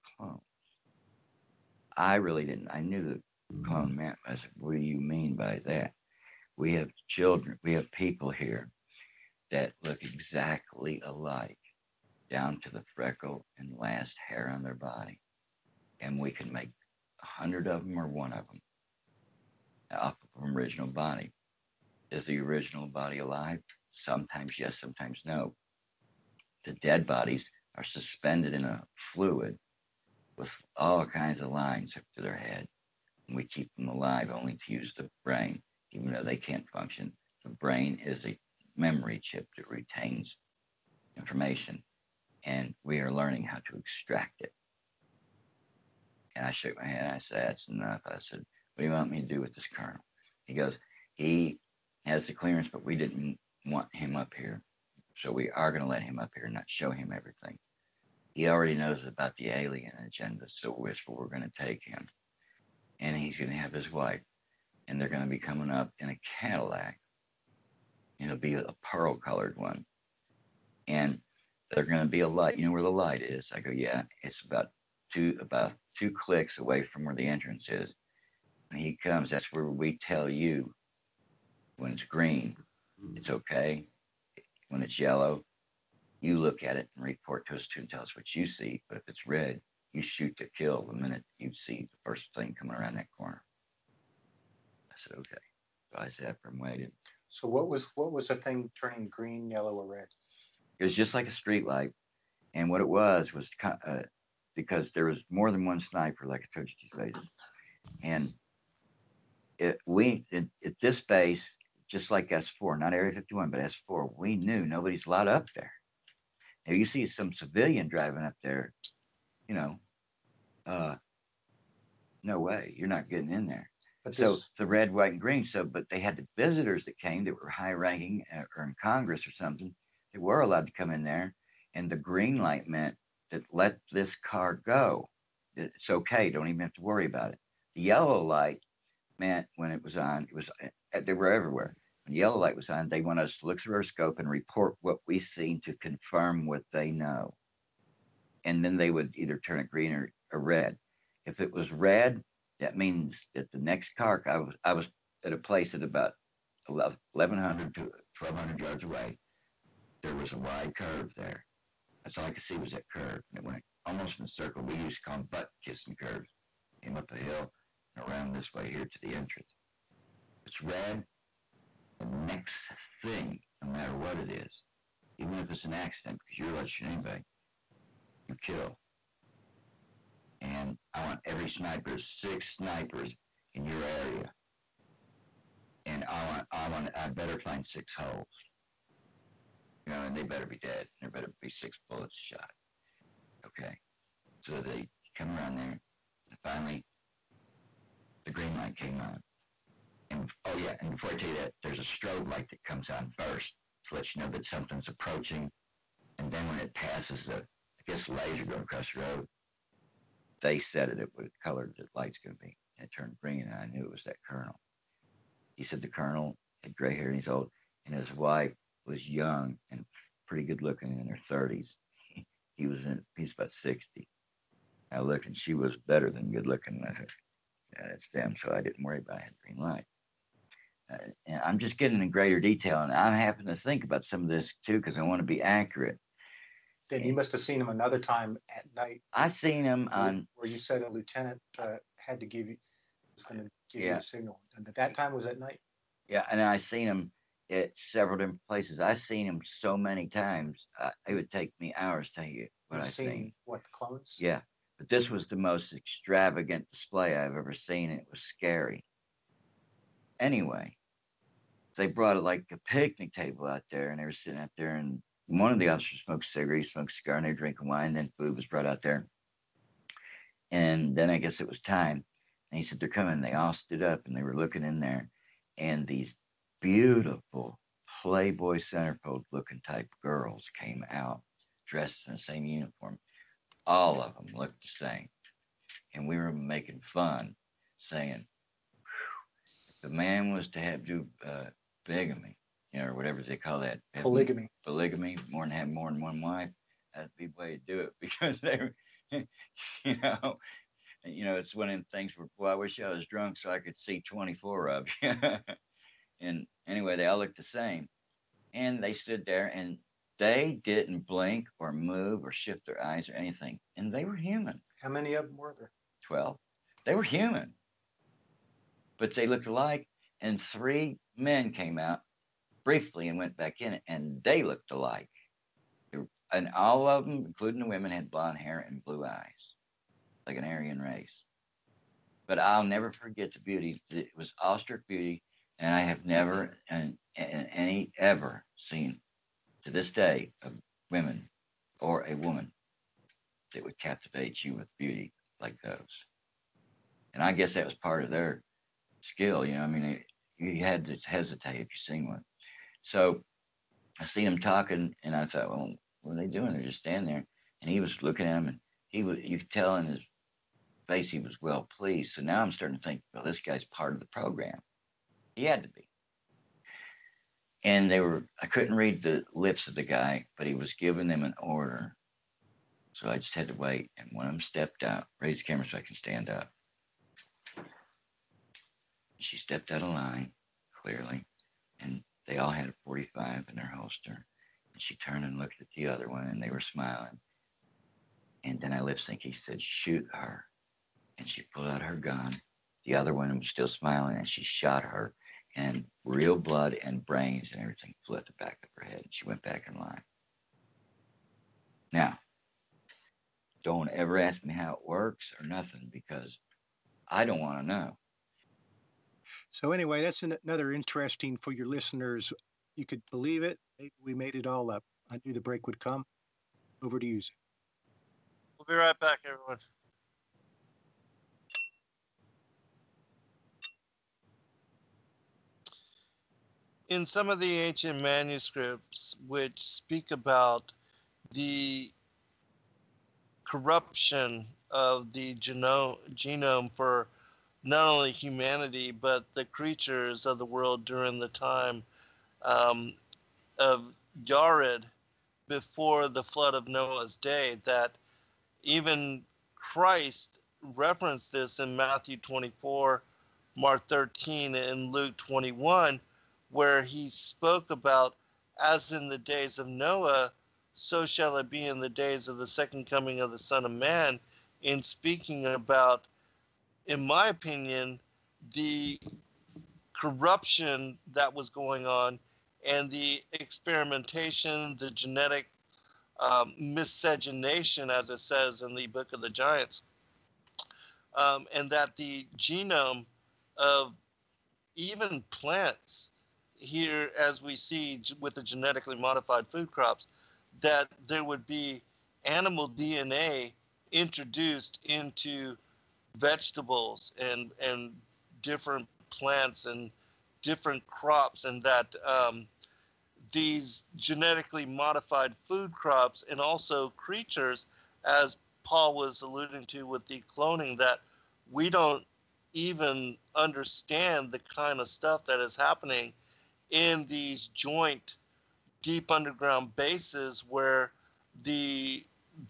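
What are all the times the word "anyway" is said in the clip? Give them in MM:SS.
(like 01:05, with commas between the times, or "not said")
04:20, 05:06, 06:49.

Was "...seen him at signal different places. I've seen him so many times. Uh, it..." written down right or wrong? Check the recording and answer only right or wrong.
wrong.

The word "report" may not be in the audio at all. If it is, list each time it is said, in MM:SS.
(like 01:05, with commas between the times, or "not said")
01:27, 02:24.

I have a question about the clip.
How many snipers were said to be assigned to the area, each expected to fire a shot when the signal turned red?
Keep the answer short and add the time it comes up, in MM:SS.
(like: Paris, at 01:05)
6, at 03:01.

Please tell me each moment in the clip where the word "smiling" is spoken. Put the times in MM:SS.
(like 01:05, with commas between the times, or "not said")
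06:26, 06:33.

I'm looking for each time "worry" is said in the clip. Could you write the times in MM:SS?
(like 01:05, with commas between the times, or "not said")
02:16, 03:48.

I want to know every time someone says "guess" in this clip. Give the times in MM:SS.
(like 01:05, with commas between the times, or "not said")
03:27, 04:31, 05:47.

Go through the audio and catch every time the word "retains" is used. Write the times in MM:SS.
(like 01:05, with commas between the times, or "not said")
00:39.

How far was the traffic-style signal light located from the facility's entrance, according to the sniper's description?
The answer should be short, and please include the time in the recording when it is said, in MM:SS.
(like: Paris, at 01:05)
2 clicks, at 01:15.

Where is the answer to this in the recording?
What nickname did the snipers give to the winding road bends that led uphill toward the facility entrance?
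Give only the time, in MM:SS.
02:45.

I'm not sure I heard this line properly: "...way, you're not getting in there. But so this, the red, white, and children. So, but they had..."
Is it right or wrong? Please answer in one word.
wrong.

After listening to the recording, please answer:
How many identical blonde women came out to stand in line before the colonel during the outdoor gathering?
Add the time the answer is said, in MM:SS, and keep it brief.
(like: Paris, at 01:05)
12, at 05:16.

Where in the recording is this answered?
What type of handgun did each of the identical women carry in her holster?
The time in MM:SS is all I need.
06:22.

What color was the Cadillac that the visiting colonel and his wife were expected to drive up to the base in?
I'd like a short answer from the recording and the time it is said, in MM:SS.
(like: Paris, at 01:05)
Pearl, at 01:08.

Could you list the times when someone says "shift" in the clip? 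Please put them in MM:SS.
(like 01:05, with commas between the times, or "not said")
05:12.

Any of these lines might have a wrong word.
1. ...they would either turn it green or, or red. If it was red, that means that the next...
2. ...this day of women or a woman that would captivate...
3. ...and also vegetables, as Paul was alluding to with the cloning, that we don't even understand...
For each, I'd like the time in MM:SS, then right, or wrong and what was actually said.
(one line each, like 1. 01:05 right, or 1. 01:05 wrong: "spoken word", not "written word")
1. 02:28 right
2. 05:39 right
3. 08:26 wrong: "creatures", not "vegetables".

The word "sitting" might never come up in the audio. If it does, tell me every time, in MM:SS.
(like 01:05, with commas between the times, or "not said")
04:24.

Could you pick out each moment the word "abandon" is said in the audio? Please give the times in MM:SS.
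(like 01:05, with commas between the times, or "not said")
not said.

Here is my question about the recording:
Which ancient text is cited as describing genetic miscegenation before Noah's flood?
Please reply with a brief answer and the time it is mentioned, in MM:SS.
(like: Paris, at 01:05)
Book of the Giants, at 07:58.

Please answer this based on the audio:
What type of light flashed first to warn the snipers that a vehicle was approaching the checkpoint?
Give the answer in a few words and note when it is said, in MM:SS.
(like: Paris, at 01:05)
Strobe light, at 03:21.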